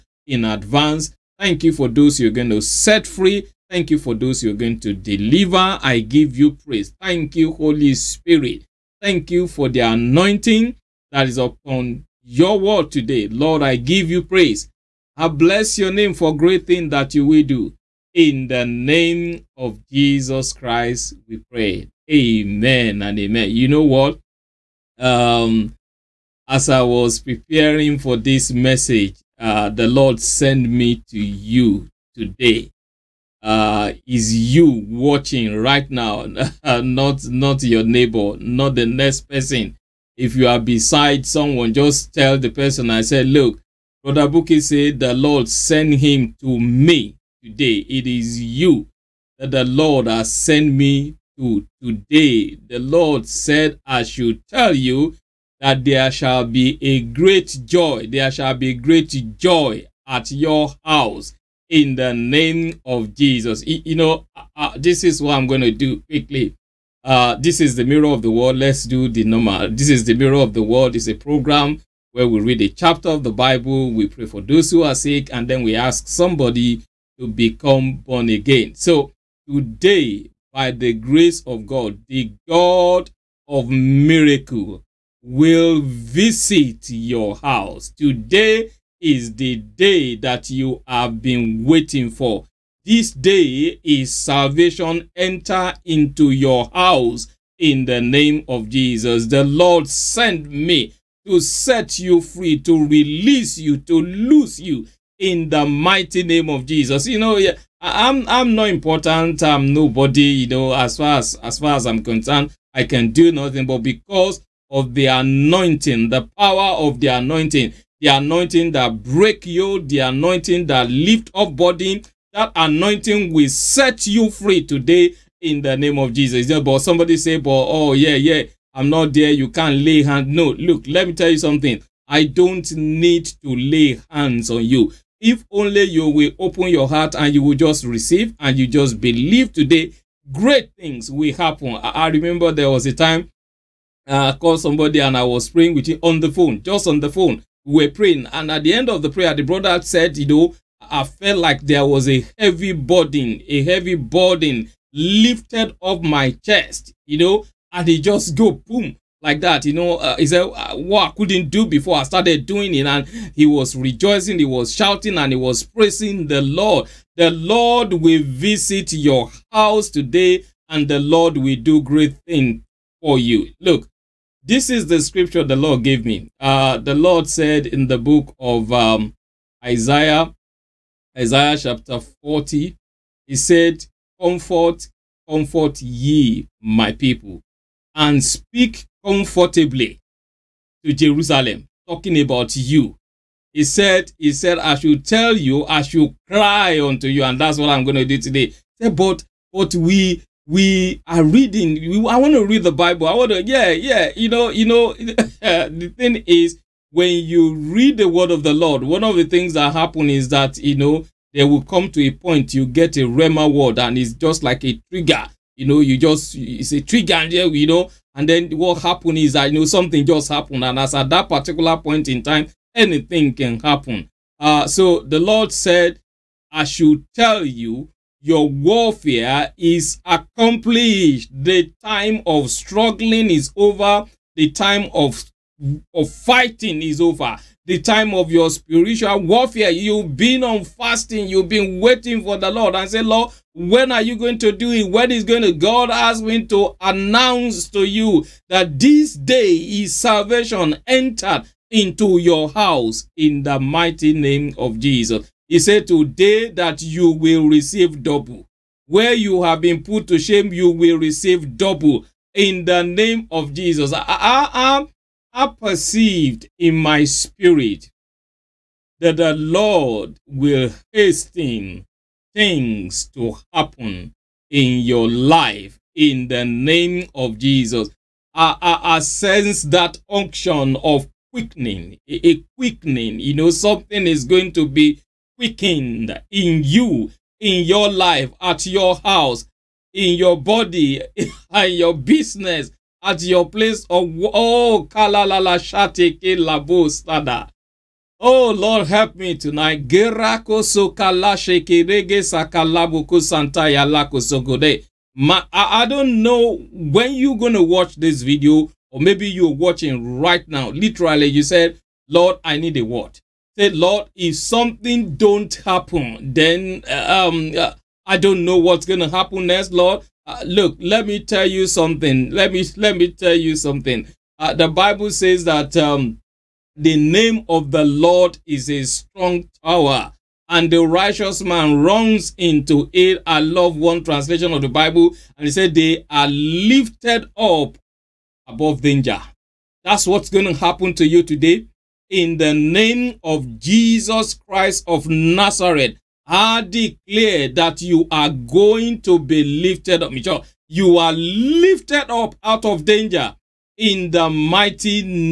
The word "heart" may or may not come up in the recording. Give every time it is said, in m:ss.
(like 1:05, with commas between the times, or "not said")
2:16.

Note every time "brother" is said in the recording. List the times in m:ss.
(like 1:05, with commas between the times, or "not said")
0:44, 2:29.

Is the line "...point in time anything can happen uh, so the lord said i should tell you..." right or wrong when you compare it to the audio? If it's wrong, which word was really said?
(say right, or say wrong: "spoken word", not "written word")
right.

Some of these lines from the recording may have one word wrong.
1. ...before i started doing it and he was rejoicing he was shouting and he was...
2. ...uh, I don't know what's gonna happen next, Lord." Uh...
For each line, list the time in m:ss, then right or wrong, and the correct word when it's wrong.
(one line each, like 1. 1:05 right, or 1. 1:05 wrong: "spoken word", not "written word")
1. 2:41 right
2. 5:17 right.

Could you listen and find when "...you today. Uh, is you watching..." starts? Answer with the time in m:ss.
0:31.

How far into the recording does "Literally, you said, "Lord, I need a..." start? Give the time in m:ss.
5:10.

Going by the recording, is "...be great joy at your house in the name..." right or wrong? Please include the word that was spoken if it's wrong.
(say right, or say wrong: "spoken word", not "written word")
right.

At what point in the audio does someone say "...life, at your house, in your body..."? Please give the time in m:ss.
4:47.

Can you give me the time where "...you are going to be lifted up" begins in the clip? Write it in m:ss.
5:47.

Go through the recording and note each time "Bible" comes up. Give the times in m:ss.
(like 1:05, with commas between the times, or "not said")
1:13, 3:22, 5:24, 5:34.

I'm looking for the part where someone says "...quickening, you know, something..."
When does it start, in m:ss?
4:42.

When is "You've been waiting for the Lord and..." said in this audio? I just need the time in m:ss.
4:01.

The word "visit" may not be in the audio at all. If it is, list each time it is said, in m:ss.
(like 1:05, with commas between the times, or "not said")
1:25, 2:48.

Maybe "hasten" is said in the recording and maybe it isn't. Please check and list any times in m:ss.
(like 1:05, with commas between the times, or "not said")
4:30.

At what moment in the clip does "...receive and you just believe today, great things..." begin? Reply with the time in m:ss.
2:17.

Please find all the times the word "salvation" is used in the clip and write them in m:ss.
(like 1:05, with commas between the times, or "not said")
1:34, 4:09.